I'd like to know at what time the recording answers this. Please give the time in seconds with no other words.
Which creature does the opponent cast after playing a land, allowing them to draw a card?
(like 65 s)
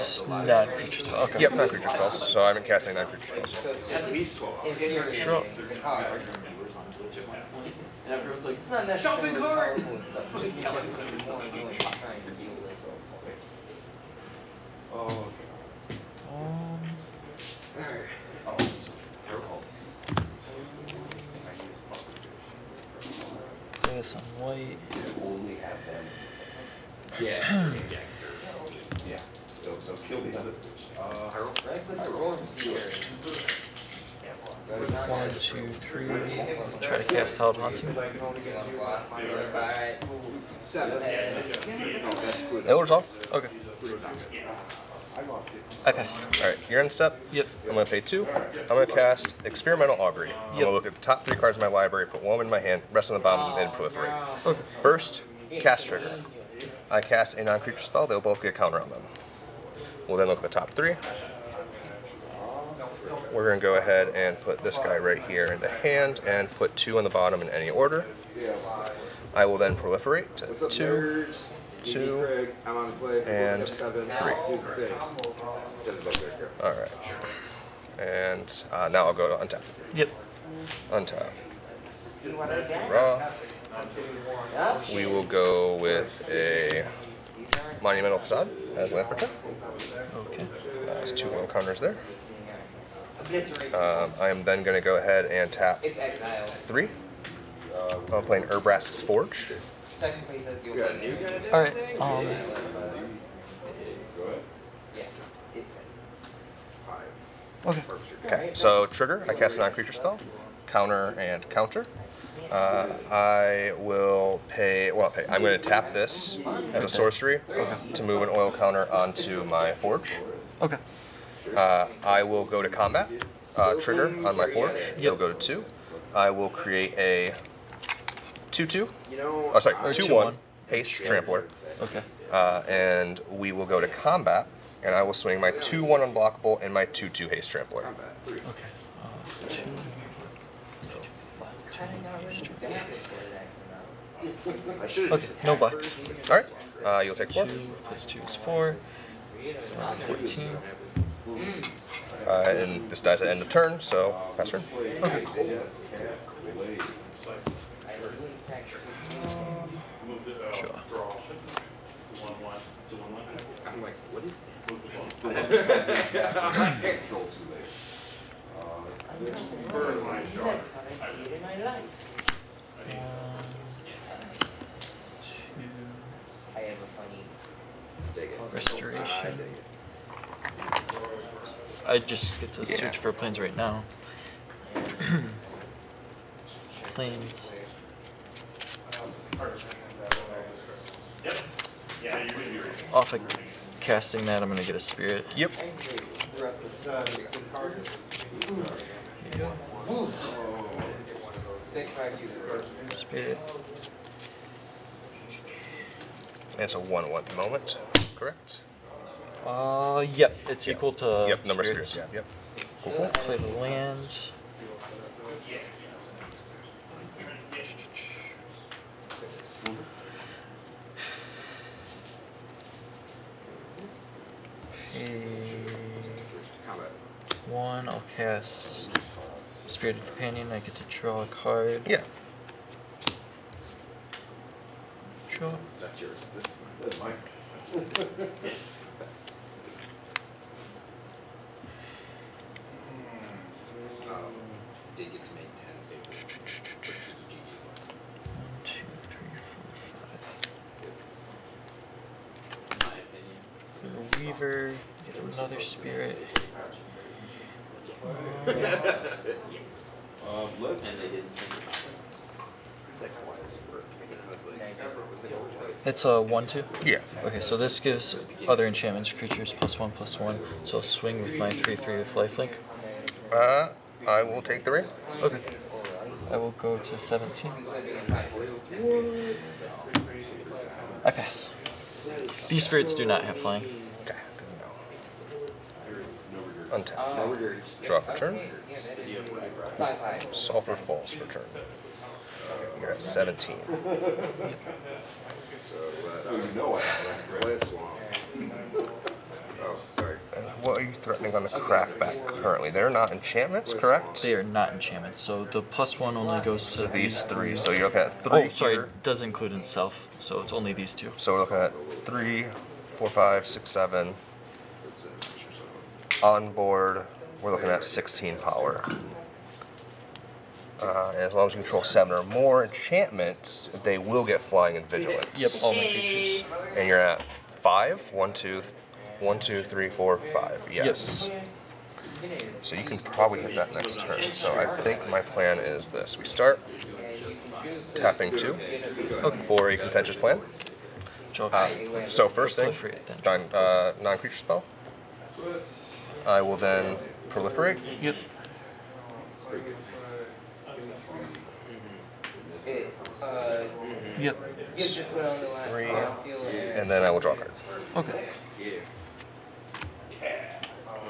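229 s.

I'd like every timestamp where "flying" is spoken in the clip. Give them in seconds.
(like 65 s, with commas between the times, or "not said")
283 s, 324 s.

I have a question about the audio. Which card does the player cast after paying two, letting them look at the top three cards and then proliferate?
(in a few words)
Experimental Augury.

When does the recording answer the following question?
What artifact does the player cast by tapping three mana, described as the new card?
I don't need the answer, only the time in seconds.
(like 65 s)
98 s.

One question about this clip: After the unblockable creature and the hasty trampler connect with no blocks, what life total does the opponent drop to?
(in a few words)
14.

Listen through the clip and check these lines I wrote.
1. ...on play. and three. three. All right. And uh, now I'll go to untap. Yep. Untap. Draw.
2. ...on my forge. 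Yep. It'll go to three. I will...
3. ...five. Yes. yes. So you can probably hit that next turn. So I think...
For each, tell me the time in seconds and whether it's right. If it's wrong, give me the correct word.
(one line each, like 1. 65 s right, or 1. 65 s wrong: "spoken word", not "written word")
1. 72 s wrong: "seven", not "three"
2. 124 s wrong: "two", not "three"
3. 330 s right.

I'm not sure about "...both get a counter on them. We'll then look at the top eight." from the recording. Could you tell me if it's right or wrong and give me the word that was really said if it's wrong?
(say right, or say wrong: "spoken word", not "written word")
wrong: "three", not "eight".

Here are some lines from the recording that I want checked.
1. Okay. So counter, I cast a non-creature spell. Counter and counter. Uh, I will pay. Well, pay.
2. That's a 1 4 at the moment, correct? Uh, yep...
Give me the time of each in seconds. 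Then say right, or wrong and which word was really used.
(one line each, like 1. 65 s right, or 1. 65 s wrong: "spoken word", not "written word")
1. 108 s wrong: "trigger", not "counter"
2. 206 s wrong: "1", not "4".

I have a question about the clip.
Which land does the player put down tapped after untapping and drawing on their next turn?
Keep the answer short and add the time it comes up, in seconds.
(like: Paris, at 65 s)
Monumental Facade, at 87 s.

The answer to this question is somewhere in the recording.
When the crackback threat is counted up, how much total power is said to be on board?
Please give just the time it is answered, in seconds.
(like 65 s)
317 s.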